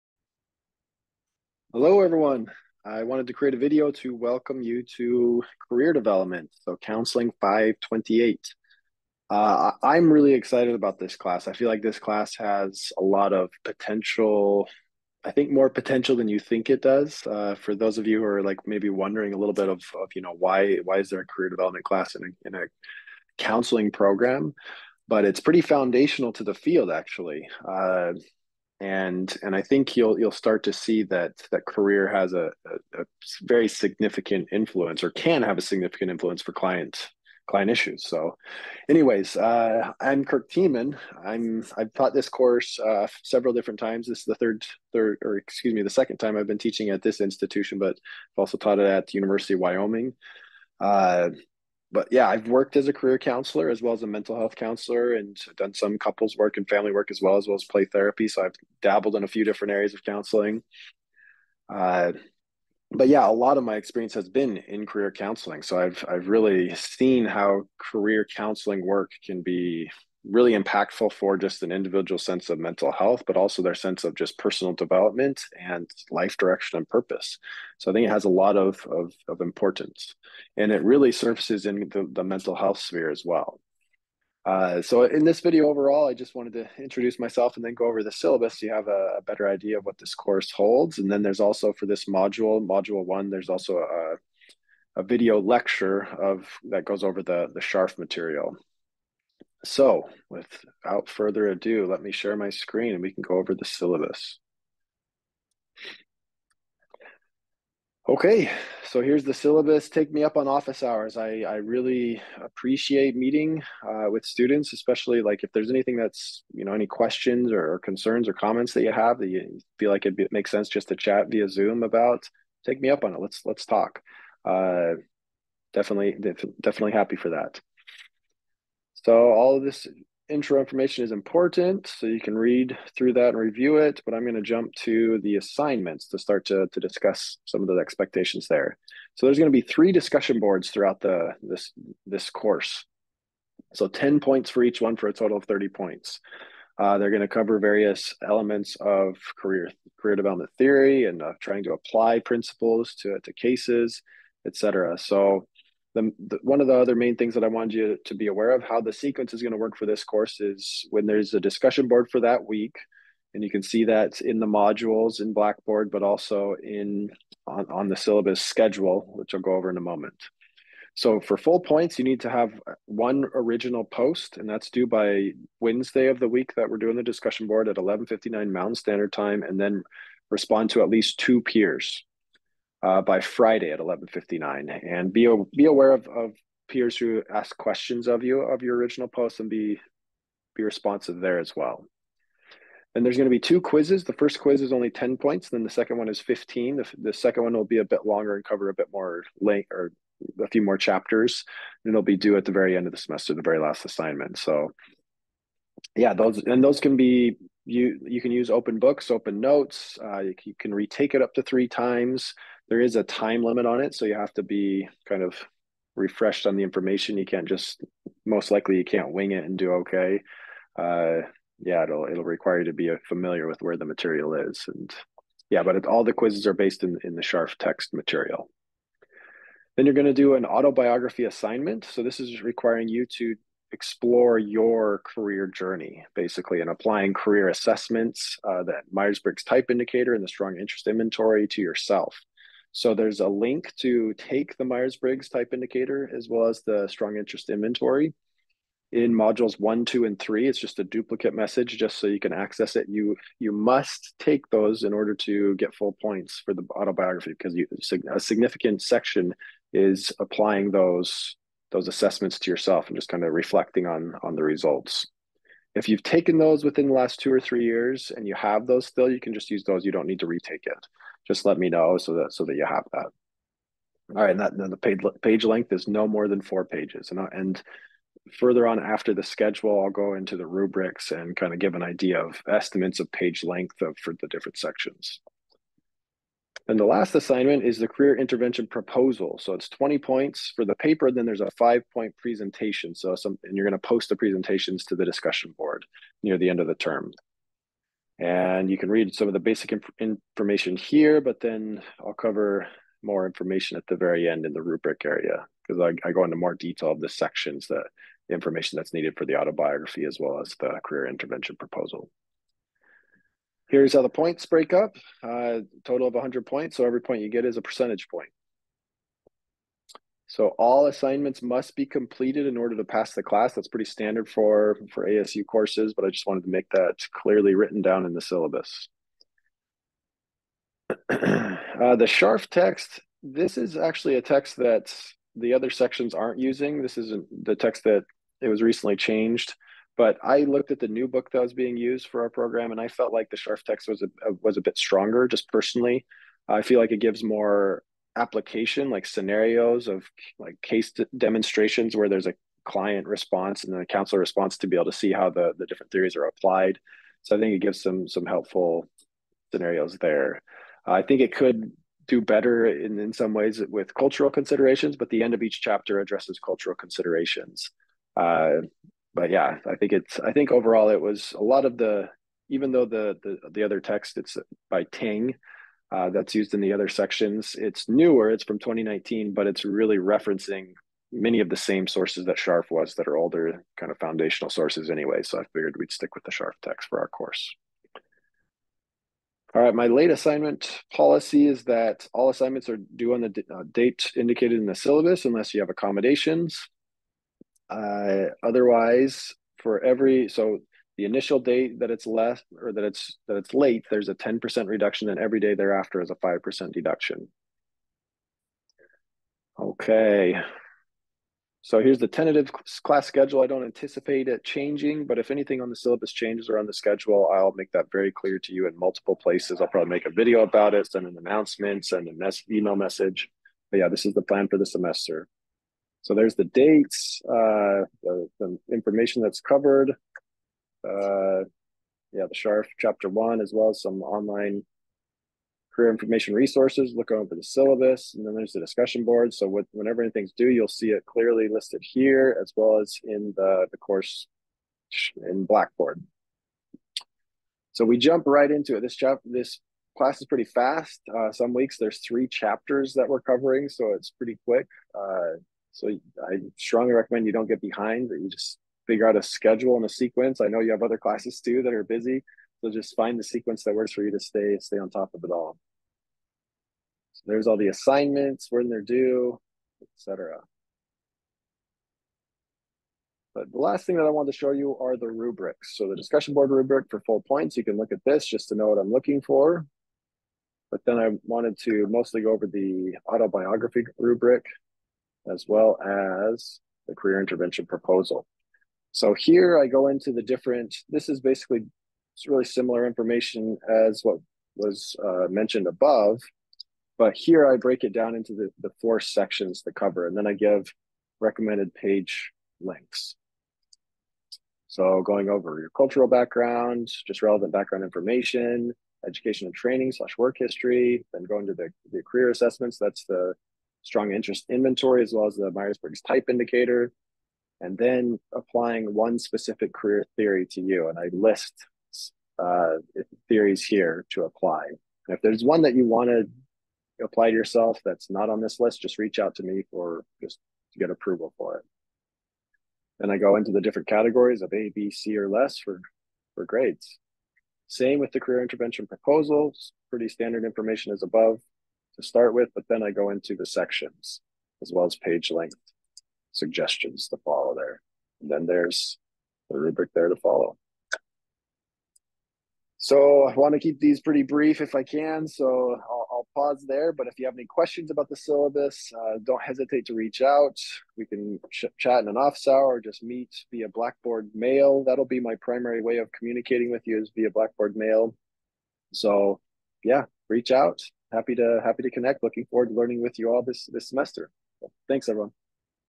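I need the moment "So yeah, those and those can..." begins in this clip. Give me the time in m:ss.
3:24.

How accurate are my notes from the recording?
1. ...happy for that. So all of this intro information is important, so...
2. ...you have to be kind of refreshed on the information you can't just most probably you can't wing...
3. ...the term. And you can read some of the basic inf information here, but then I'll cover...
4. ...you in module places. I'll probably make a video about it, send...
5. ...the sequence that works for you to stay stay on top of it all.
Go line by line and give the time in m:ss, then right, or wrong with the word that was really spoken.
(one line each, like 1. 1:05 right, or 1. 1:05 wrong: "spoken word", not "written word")
1. 2:06 right
2. 3:34 wrong: "likely", not "probably"
3. 4:56 right
4. 6:58 wrong: "multiple", not "module"
5. 7:43 right.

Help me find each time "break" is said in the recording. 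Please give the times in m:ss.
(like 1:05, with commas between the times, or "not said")
5:14, 8:17.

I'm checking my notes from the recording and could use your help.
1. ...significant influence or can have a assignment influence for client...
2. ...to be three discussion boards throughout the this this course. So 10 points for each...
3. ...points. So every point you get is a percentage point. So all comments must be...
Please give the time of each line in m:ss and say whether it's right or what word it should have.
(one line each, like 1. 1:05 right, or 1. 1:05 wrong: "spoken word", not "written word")
1. 0:33 wrong: "significant", not "assignment"
2. 2:19 right
3. 5:16 wrong: "assignments", not "comments".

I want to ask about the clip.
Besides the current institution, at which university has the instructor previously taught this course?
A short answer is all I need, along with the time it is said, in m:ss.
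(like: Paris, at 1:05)
University of Wyoming, at 0:49.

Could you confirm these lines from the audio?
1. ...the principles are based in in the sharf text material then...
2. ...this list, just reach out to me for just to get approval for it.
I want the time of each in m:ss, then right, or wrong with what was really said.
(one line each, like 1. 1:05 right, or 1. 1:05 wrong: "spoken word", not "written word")
1. 3:46 wrong: "quizzes", not "principles"
2. 8:48 right.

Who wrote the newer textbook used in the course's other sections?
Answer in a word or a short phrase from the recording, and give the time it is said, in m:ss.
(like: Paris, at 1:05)
Tang, at 6:14.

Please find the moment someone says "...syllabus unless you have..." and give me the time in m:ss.
6:34.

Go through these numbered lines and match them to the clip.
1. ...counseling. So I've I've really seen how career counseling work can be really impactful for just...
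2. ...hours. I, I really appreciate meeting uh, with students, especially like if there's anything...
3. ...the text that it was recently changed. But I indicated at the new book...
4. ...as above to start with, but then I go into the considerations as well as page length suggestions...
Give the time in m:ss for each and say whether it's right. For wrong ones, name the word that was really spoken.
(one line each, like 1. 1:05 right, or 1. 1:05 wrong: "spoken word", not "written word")
1. 1:05 right
2. 1:50 right
3. 5:37 wrong: "looked", not "indicated"
4. 9:00 wrong: "sections", not "considerations".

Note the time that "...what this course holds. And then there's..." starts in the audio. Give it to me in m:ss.
1:29.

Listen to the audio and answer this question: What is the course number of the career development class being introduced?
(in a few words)
528.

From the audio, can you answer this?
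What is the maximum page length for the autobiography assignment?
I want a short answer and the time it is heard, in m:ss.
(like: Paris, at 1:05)
4 pages, at 4:36.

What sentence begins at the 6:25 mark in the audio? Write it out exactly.
So I figured we'd stick with the Sharf text for our course.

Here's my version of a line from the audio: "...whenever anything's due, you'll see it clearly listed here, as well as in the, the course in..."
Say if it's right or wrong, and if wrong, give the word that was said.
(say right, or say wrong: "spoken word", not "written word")
right.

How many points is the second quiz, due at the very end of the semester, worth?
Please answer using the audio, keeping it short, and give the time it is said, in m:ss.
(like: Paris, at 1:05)
15, at 3:16.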